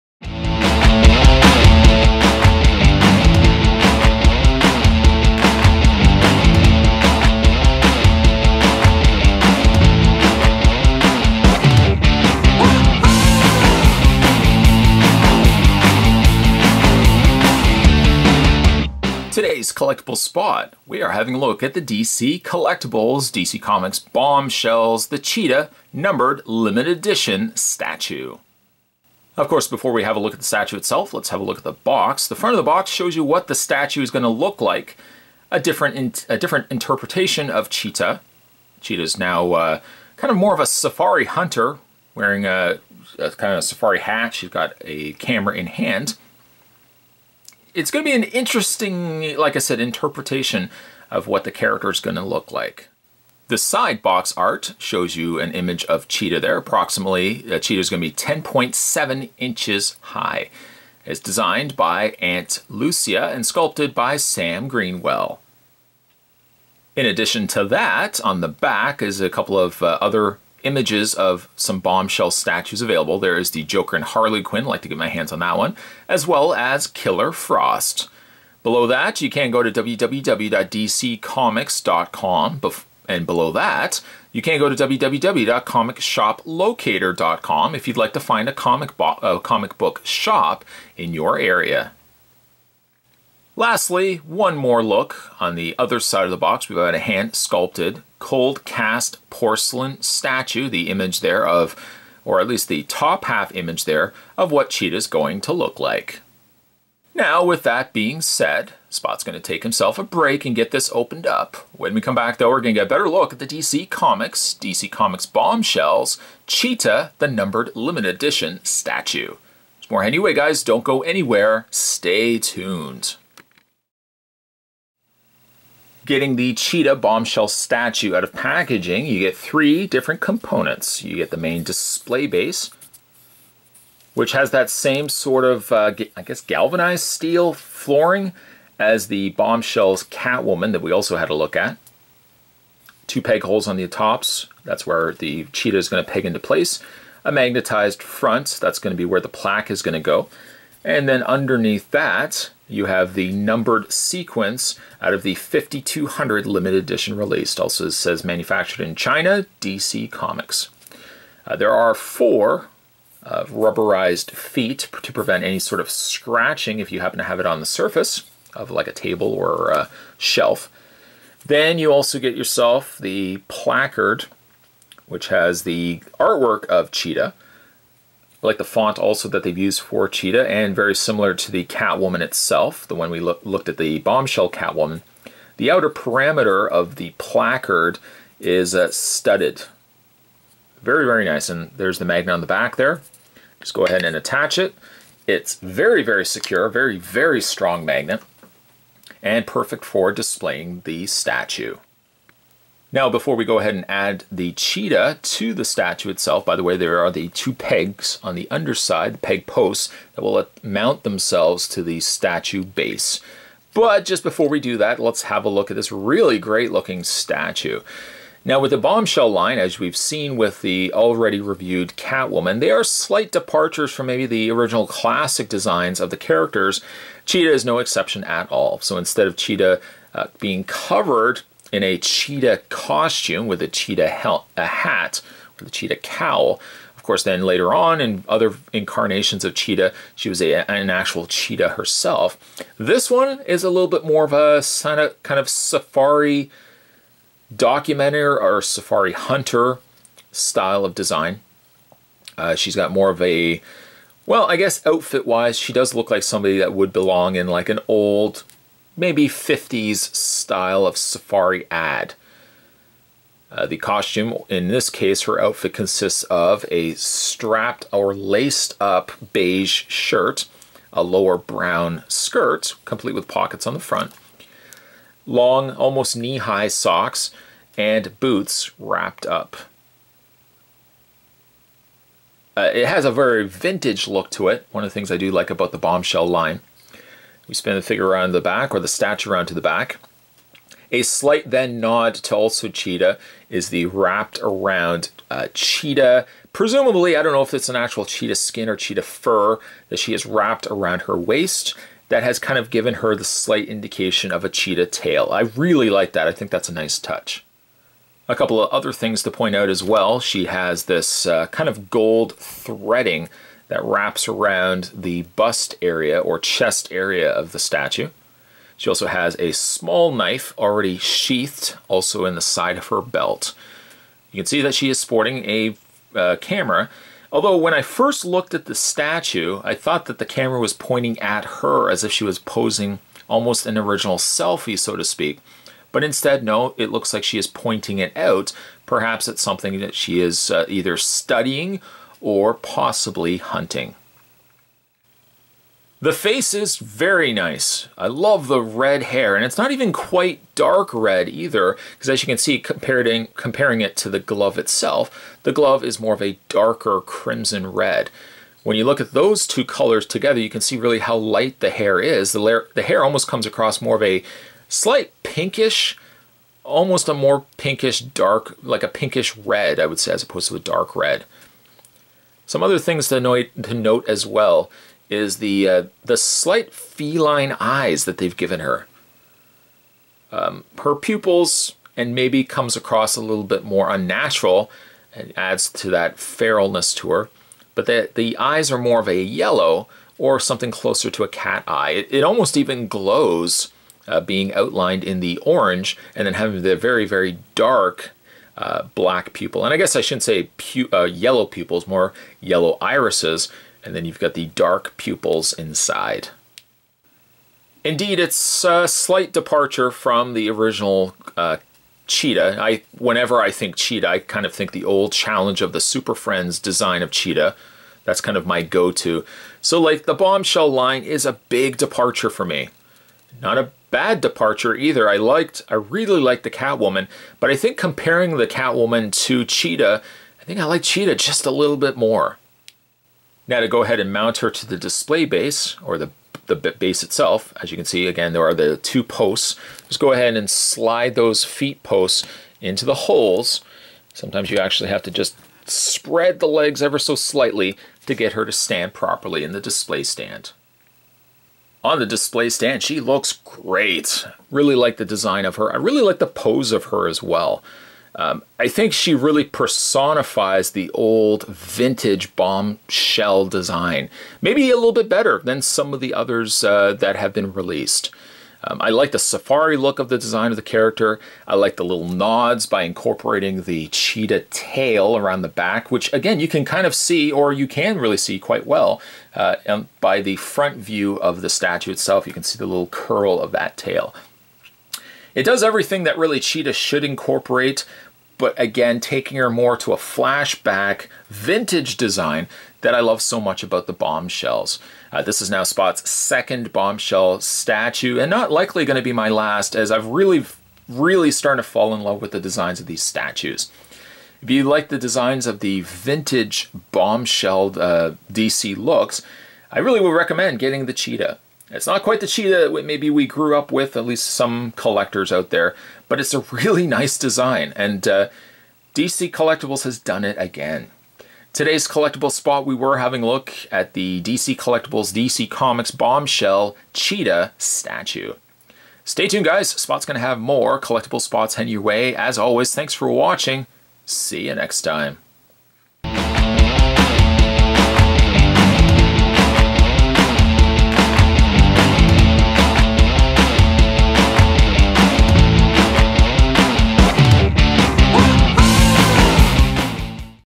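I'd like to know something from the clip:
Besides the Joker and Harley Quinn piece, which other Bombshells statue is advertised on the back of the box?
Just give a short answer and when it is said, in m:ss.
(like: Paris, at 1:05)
Killer Frost, at 1:16.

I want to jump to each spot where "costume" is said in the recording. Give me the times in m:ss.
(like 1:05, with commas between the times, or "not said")
3:52, 4:23.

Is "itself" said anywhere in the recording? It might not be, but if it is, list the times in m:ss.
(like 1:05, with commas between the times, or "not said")
0:30, 3:02, 3:26, 5:54, 7:17, 8:01.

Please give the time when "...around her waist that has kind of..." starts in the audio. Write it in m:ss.
5:00.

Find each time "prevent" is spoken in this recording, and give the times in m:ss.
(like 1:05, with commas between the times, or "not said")
2:45.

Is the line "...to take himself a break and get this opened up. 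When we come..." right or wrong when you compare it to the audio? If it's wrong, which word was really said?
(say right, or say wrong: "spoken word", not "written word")
right.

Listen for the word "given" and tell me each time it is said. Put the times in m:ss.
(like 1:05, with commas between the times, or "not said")
5:02, 6:18.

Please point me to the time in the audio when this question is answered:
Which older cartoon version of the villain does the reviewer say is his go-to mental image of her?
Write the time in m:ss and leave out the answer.
6:55.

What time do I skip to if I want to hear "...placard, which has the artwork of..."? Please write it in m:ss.
2:53.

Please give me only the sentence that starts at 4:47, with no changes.
We spin the figure around the back or the statue around to the back.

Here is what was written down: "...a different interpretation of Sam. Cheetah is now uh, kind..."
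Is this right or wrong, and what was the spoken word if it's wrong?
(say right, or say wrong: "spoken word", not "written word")
wrong: "Cheetah", not "Sam".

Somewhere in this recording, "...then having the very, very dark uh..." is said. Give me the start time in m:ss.
6:36.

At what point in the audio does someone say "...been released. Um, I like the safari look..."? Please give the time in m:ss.
7:47.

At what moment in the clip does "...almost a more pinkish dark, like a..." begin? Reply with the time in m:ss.
6:06.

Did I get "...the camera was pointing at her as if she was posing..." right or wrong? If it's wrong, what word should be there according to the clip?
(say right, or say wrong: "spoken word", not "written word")
right.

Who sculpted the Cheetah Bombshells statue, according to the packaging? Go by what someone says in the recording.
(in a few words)
Sam Greenwell.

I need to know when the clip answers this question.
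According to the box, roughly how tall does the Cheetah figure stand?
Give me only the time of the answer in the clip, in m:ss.
0:58.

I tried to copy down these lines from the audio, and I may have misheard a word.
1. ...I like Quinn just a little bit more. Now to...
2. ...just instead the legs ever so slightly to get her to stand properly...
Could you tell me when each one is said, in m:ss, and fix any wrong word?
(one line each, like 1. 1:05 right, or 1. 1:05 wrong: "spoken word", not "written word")
1. 7:10 wrong: "Cheetah", not "Quinn"
2. 7:25 wrong: "spread", not "instead".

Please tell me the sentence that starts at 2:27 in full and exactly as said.
A magnetized front, that's going to be where the plaque is going to go.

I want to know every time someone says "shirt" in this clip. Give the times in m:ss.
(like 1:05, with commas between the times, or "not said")
4:29.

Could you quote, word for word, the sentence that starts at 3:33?
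But just before we do that, let's have a look at this really great looking statue.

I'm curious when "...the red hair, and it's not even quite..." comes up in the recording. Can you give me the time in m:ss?
5:48.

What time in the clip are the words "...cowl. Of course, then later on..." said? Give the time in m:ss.
3:55.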